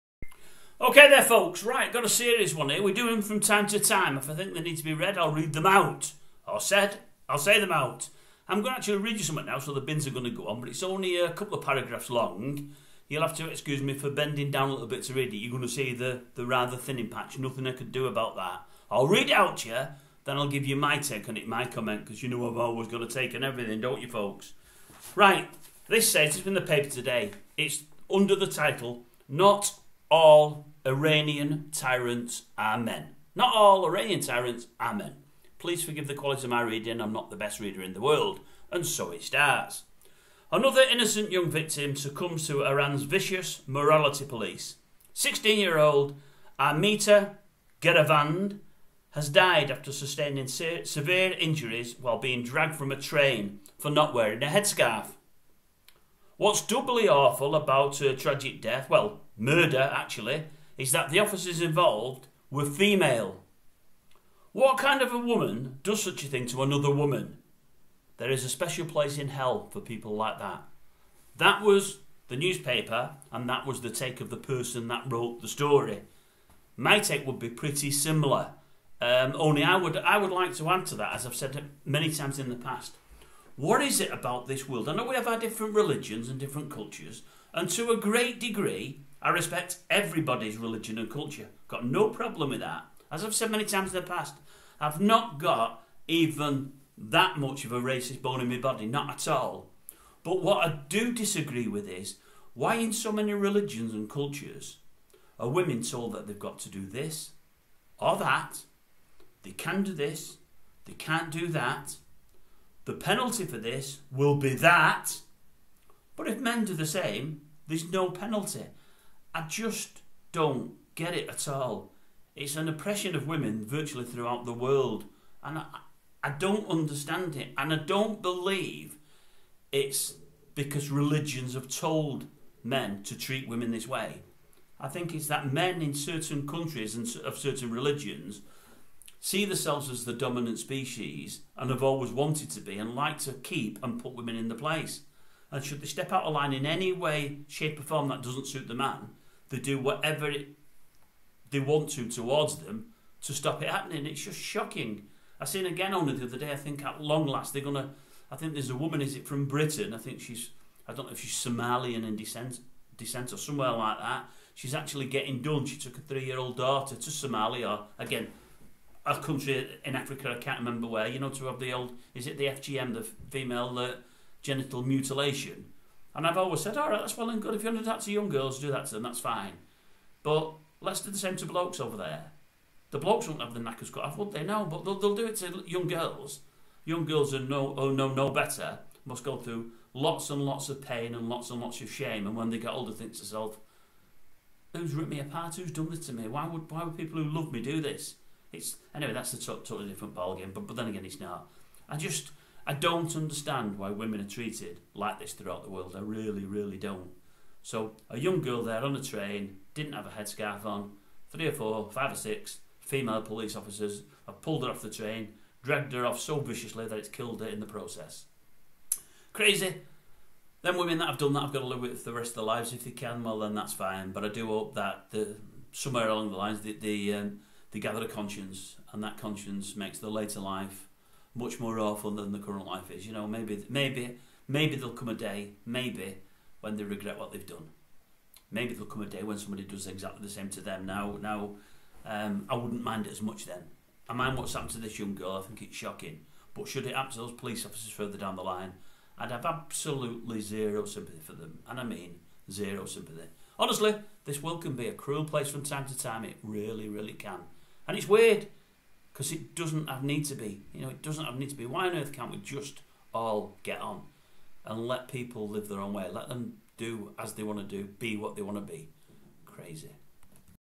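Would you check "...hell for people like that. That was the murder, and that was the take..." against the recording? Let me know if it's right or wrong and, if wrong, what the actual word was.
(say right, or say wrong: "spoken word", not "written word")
wrong: "newspaper", not "murder".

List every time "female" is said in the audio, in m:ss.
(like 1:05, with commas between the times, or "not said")
1:02, 2:53, 3:32.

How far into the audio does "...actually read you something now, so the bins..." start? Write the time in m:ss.
0:08.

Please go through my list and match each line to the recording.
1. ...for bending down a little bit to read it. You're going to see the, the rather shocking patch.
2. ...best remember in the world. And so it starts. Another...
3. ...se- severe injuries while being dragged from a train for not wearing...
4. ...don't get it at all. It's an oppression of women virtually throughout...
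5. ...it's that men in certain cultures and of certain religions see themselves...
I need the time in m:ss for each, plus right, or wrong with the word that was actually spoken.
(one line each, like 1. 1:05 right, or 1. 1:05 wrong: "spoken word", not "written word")
1. 0:13 wrong: "thinning", not "shocking"
2. 0:37 wrong: "reader", not "remember"
3. 0:50 right
4. 2:00 right
5. 2:15 wrong: "countries", not "cultures".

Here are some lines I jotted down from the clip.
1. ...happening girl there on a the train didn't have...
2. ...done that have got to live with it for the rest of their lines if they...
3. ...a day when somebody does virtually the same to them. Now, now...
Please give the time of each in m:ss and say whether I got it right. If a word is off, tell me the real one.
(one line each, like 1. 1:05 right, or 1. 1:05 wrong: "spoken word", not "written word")
1. 3:28 wrong: "young", not "happening"
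2. 3:41 wrong: "lives", not "lines"
3. 3:59 wrong: "exactly", not "virtually".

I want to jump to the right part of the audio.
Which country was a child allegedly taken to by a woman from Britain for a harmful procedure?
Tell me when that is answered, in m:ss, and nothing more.
2:47.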